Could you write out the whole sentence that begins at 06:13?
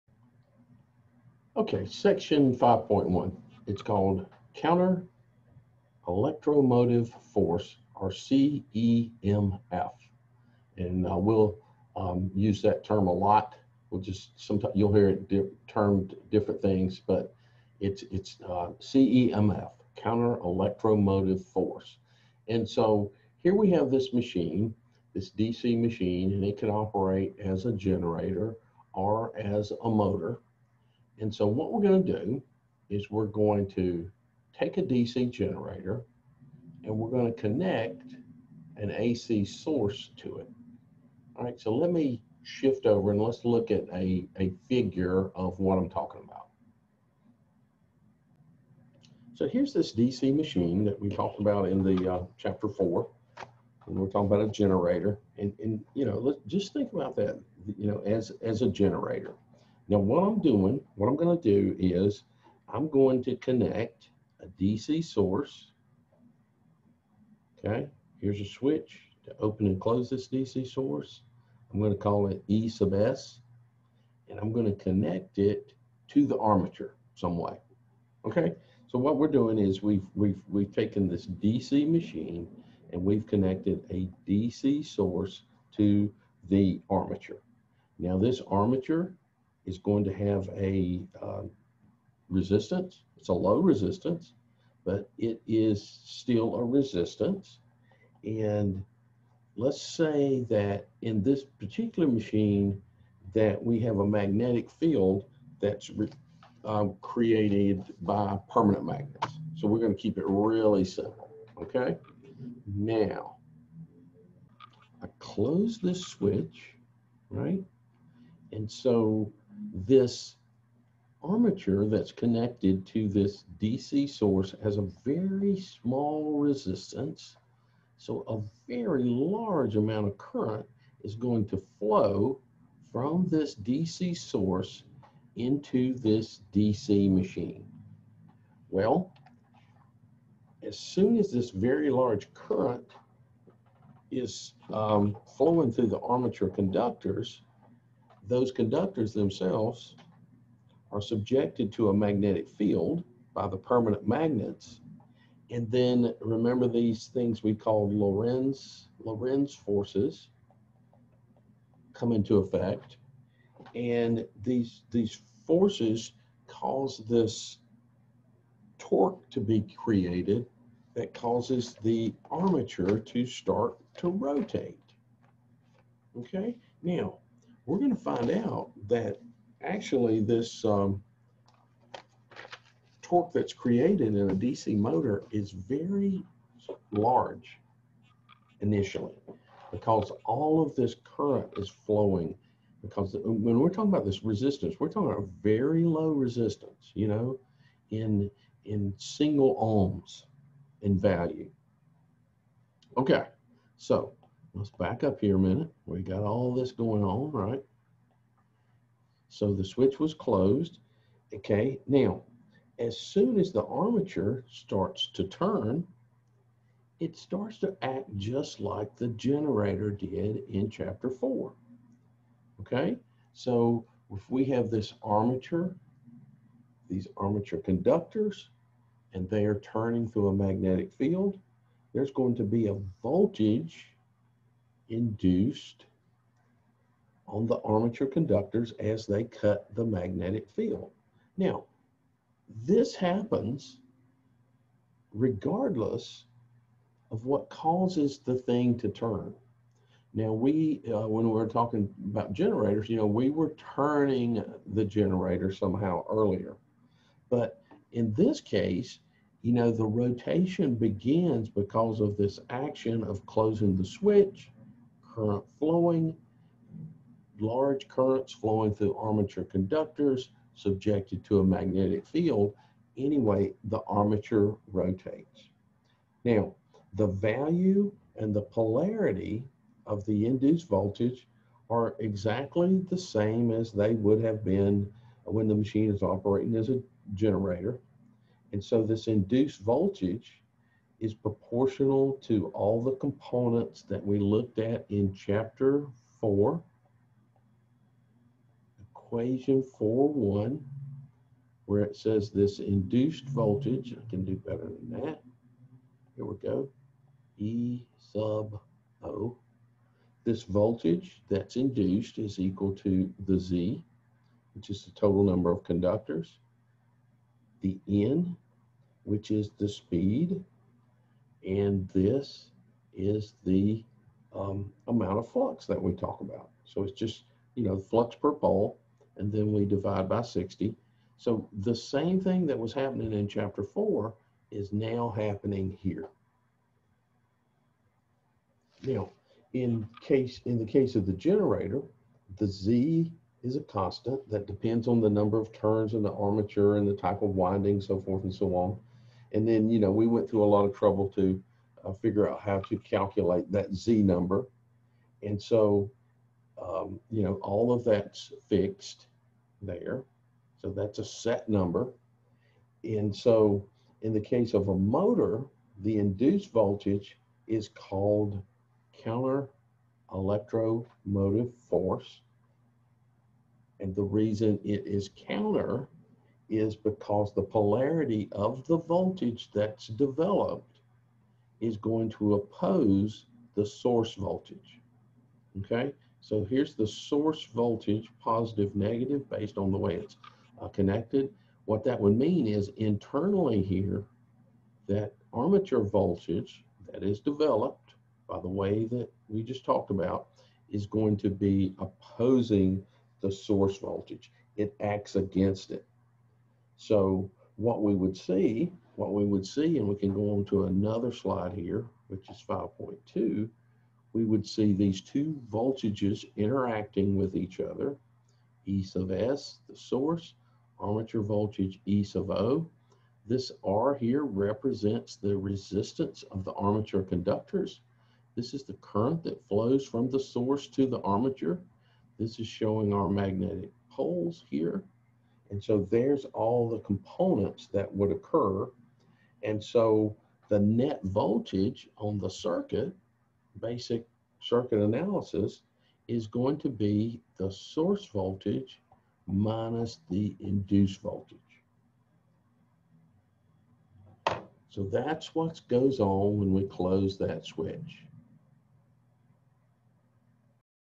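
And the reason it is counter is because the polarity of the voltage that's developed is going to oppose the source voltage.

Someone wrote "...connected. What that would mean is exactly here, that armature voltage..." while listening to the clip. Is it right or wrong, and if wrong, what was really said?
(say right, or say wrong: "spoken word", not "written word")
wrong: "internally", not "exactly".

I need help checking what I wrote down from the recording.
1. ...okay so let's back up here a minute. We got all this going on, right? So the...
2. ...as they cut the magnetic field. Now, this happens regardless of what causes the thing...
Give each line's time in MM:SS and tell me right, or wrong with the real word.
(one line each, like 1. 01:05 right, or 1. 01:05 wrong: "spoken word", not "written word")
1. 03:22 right
2. 03:58 right.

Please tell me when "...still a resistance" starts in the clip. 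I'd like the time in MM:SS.
01:36.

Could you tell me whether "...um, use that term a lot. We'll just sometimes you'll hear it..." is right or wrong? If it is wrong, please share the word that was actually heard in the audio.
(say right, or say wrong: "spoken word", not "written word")
right.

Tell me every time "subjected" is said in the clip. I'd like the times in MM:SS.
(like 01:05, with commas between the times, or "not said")
02:31, 04:30.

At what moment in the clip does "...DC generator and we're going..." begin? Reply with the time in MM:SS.
00:34.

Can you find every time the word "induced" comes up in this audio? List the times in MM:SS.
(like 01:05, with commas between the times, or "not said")
03:54, 04:40, 04:49, 05:02, 05:11, 06:05, 07:30.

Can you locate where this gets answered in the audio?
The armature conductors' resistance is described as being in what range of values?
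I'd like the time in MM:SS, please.
03:18.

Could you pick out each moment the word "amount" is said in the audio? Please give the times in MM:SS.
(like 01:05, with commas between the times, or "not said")
02:09, 05:24.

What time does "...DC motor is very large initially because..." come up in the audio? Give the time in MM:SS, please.
03:04.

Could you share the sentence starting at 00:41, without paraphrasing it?
All right, so let me shift over and let's look at a, a figure of what I'm talking about.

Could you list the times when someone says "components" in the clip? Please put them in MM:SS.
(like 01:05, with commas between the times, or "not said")
04:52, 07:16.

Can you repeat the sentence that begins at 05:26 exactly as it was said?
So it's just, you know, flux per pole, and then we divide by 60.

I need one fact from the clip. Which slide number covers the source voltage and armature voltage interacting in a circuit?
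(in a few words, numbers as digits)
5.2.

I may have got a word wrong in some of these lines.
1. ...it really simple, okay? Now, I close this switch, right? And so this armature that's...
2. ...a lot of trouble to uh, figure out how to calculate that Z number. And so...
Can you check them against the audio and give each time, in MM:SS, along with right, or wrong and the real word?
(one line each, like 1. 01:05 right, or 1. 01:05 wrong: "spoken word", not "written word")
1. 01:50 right
2. 05:50 right.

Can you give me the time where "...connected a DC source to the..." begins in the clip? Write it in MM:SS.
01:23.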